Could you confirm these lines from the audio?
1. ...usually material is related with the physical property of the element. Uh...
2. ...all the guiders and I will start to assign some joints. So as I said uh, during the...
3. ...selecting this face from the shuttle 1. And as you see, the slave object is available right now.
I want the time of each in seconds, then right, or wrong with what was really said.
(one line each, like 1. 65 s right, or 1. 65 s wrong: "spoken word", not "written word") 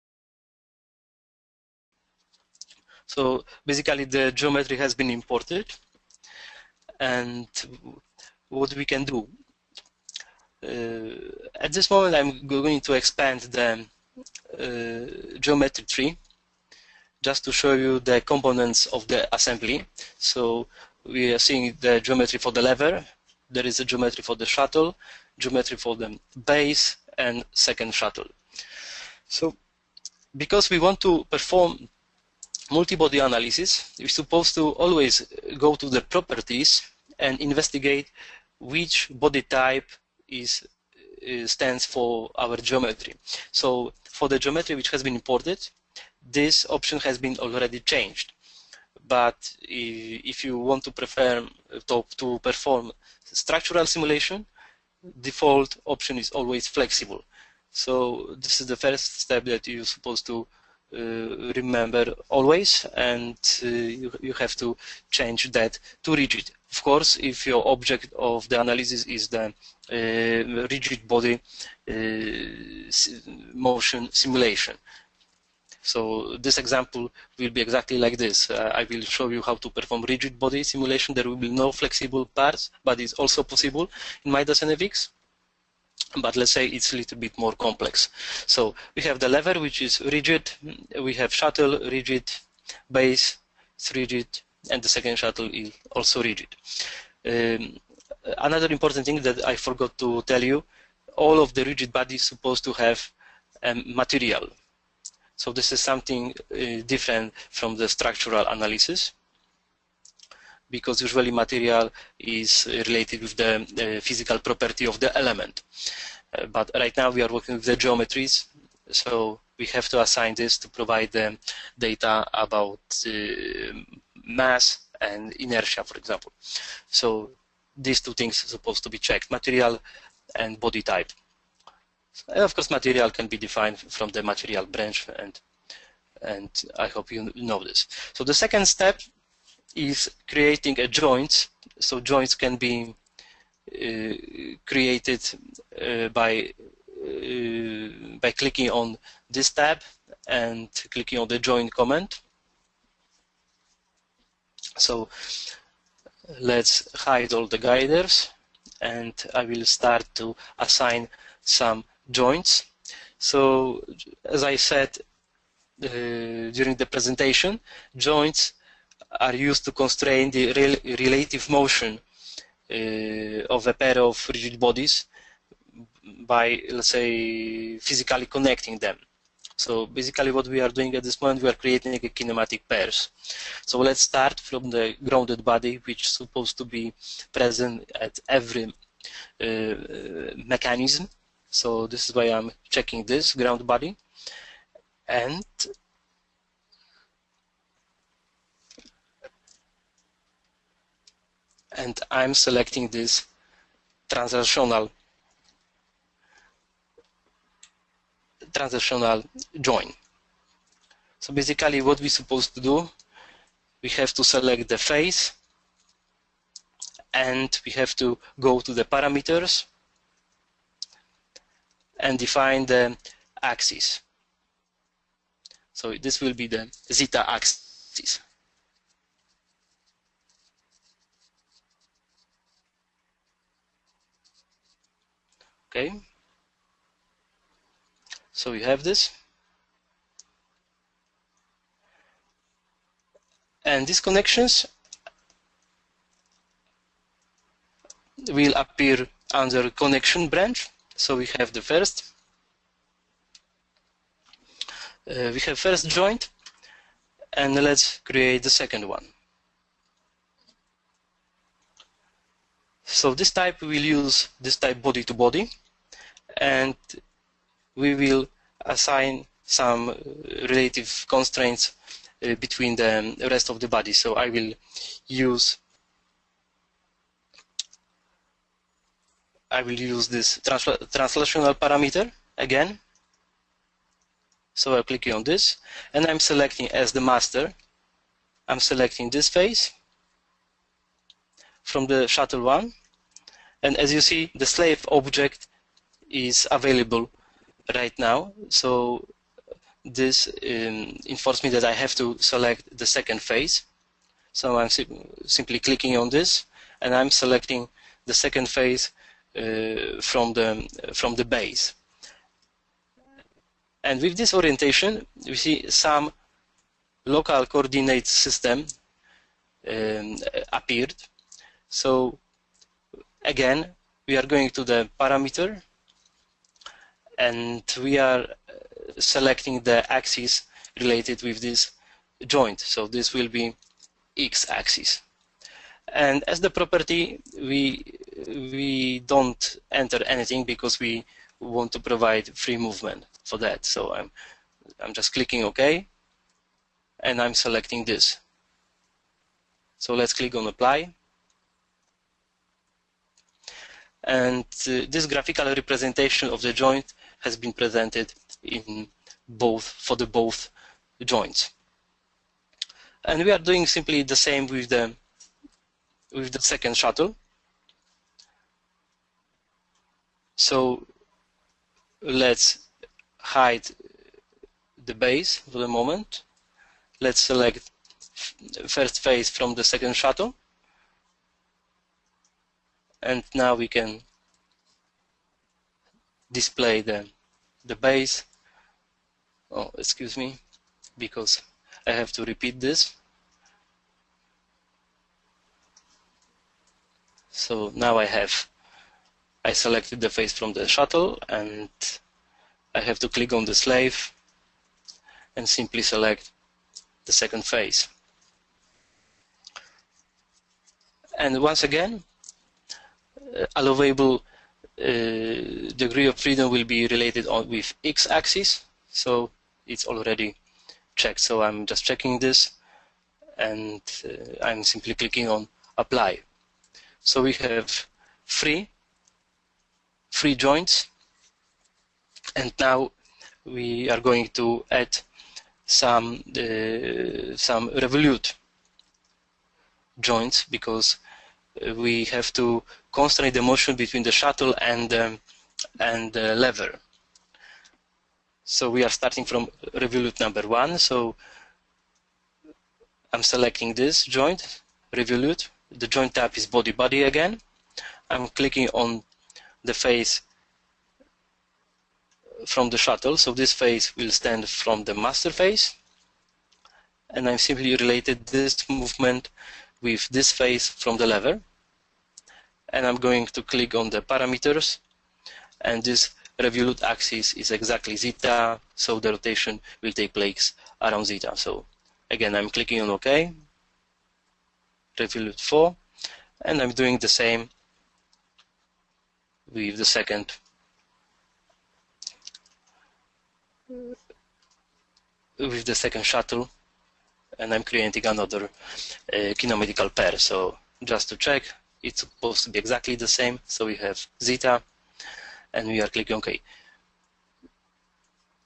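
1. 111 s right
2. 157 s right
3. 288 s right.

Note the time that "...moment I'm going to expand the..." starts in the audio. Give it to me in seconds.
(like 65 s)
11 s.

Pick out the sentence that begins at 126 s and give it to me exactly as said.
So these two things are supposed to be checked, material and body type.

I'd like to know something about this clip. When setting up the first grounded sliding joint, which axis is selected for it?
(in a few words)
zeta axis.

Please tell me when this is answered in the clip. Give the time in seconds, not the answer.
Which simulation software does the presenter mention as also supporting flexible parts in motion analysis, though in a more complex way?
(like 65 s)
84 s.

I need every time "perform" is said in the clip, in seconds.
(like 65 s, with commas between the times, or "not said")
31 s, 52 s, 79 s.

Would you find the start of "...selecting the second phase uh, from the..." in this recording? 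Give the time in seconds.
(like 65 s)
307 s.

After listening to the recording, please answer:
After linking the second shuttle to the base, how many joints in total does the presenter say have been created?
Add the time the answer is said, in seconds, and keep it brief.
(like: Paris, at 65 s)
3, at 428 s.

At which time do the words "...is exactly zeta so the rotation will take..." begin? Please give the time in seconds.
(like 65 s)
477 s.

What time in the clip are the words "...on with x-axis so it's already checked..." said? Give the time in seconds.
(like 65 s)
417 s.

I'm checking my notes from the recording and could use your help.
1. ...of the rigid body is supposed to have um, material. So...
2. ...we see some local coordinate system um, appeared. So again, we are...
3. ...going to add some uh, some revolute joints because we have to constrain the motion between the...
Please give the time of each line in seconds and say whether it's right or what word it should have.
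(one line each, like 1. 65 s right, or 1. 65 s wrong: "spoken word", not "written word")
1. 101 s right
2. 315 s right
3. 433 s right.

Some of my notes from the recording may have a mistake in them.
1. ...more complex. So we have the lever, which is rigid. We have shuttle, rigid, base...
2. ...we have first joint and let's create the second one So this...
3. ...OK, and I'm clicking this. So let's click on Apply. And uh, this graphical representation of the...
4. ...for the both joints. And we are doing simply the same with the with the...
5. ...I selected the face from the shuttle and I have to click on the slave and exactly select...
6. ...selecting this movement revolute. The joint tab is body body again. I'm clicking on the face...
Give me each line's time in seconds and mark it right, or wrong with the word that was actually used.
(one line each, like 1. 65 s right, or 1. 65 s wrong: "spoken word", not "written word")
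1. 87 s right
2. 255 s right
3. 345 s wrong: "selecting", not "clicking"
4. 359 s right
5. 399 s wrong: "simply", not "exactly"
6. 453 s wrong: "joint", not "movement".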